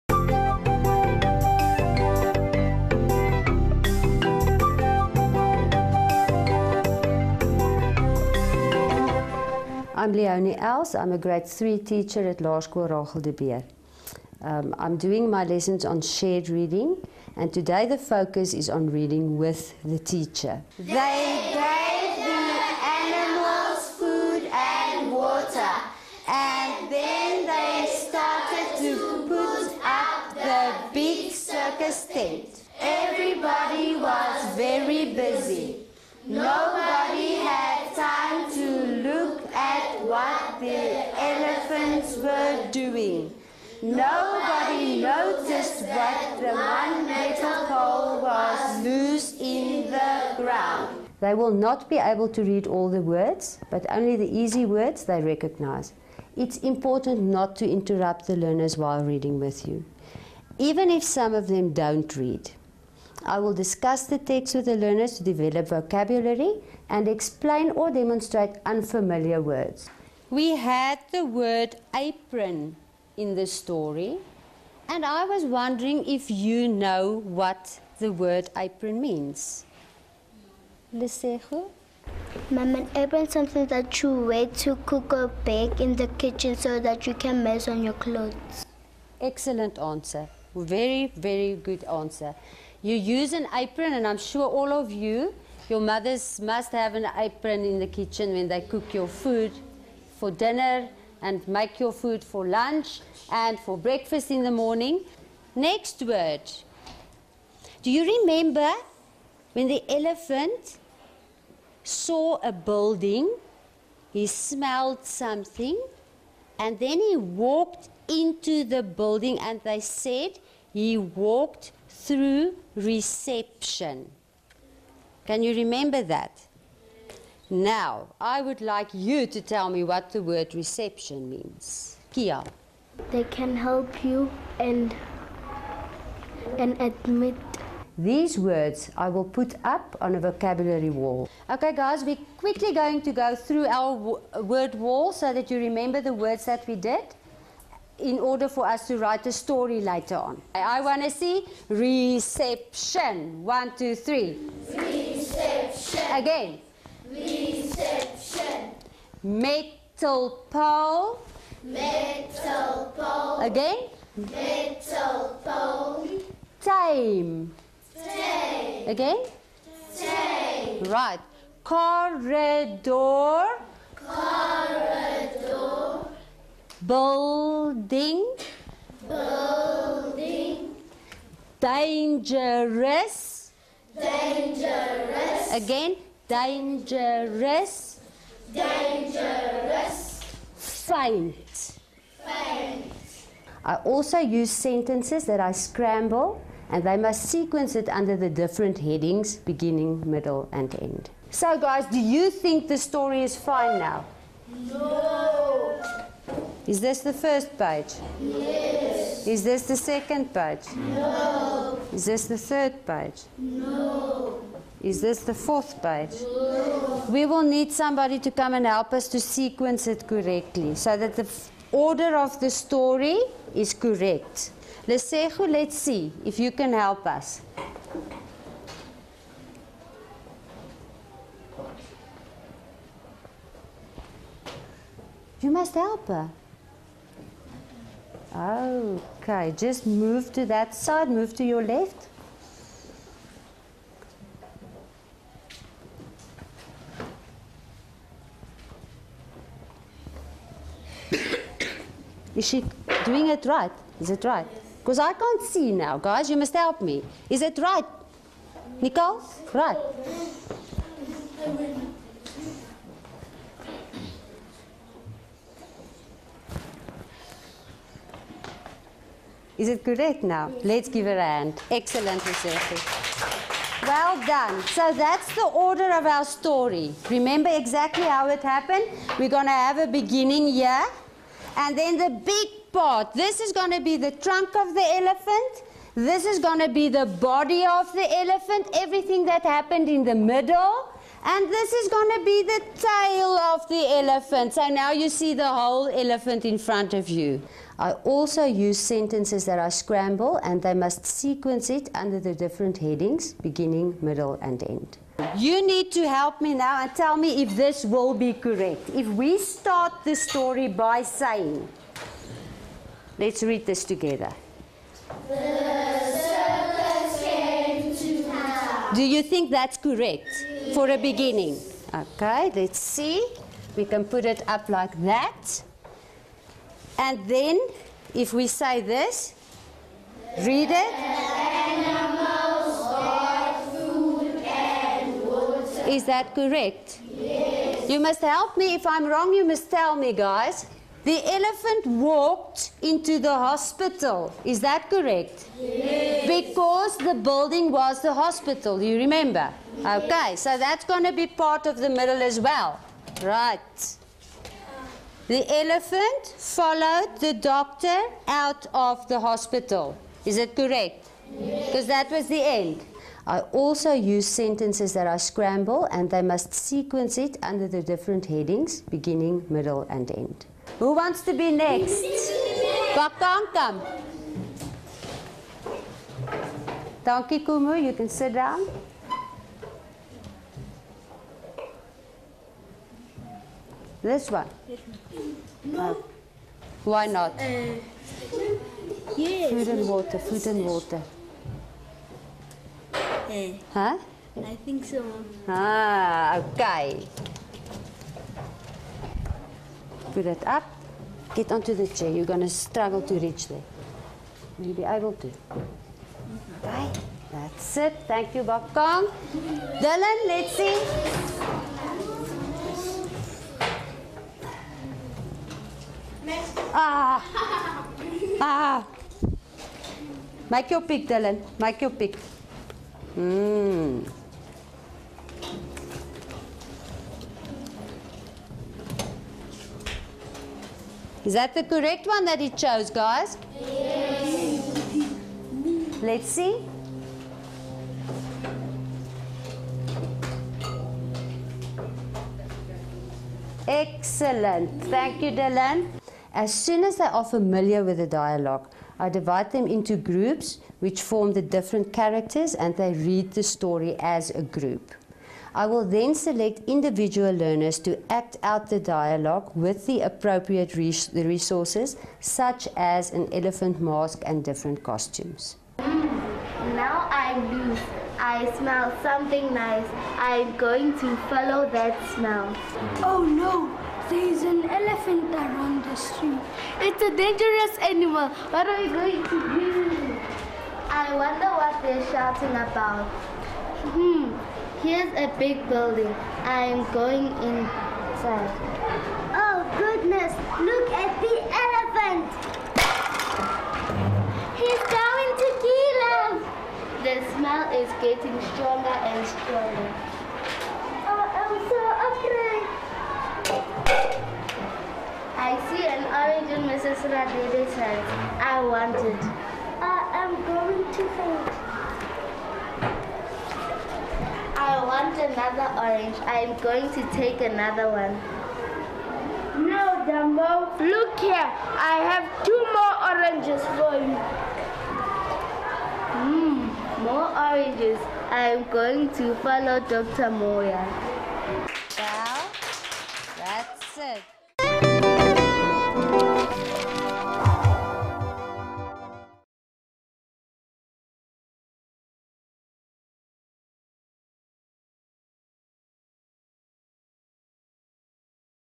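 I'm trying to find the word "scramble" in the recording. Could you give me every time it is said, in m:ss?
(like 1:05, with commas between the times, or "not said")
3:15, 4:59, 6:05.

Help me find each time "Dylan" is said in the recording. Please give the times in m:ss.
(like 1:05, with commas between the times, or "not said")
6:49, 7:01, 7:25.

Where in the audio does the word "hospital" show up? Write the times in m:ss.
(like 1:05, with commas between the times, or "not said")
5:43, 5:48, 5:59.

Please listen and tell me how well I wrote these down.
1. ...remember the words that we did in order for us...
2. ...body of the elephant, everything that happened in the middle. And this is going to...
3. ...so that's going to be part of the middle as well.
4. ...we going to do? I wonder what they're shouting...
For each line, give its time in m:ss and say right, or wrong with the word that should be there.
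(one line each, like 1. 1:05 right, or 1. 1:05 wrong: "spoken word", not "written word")
1. 2:25 right
2. 4:47 right
3. 5:50 right
4. 7:58 right.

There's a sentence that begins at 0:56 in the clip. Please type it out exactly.
It's important not to interrupt the learners while reading with you, even if some of them don't read.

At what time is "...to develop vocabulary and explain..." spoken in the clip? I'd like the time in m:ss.
1:05.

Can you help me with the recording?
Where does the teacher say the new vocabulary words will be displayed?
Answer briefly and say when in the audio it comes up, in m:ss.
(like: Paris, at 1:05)
vocabulary wall, at 2:20.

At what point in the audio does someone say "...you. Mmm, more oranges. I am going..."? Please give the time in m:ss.
8:44.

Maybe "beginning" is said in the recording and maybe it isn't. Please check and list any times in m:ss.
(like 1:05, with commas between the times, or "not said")
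3:19, 4:39, 5:03, 5:20, 6:08.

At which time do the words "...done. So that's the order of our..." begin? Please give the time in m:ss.
4:34.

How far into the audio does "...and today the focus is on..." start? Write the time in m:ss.
0:17.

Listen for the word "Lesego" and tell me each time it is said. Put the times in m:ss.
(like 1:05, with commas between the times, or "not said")
1:20, 3:44.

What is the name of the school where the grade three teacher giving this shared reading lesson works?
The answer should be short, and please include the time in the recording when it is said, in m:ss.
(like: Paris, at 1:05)
Laerskool Rachel de Beer, at 0:12.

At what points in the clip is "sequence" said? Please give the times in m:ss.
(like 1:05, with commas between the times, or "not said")
3:17, 3:39, 5:01, 6:06.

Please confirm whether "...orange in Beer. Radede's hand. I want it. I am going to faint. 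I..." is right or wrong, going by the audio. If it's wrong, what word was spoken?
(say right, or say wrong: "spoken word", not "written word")
wrong: "Mrs", not "Beer".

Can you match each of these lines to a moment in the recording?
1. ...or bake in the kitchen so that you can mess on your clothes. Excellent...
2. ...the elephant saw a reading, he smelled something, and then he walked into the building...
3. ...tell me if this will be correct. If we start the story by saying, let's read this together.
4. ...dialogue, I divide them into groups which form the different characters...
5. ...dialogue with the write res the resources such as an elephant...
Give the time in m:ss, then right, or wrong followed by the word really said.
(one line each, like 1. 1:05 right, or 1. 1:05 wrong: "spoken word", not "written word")
1. 1:25 right
2. 1:49 wrong: "building", not "reading"
3. 5:06 right
4. 7:28 right
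5. 7:38 wrong: "appropriate", not "write".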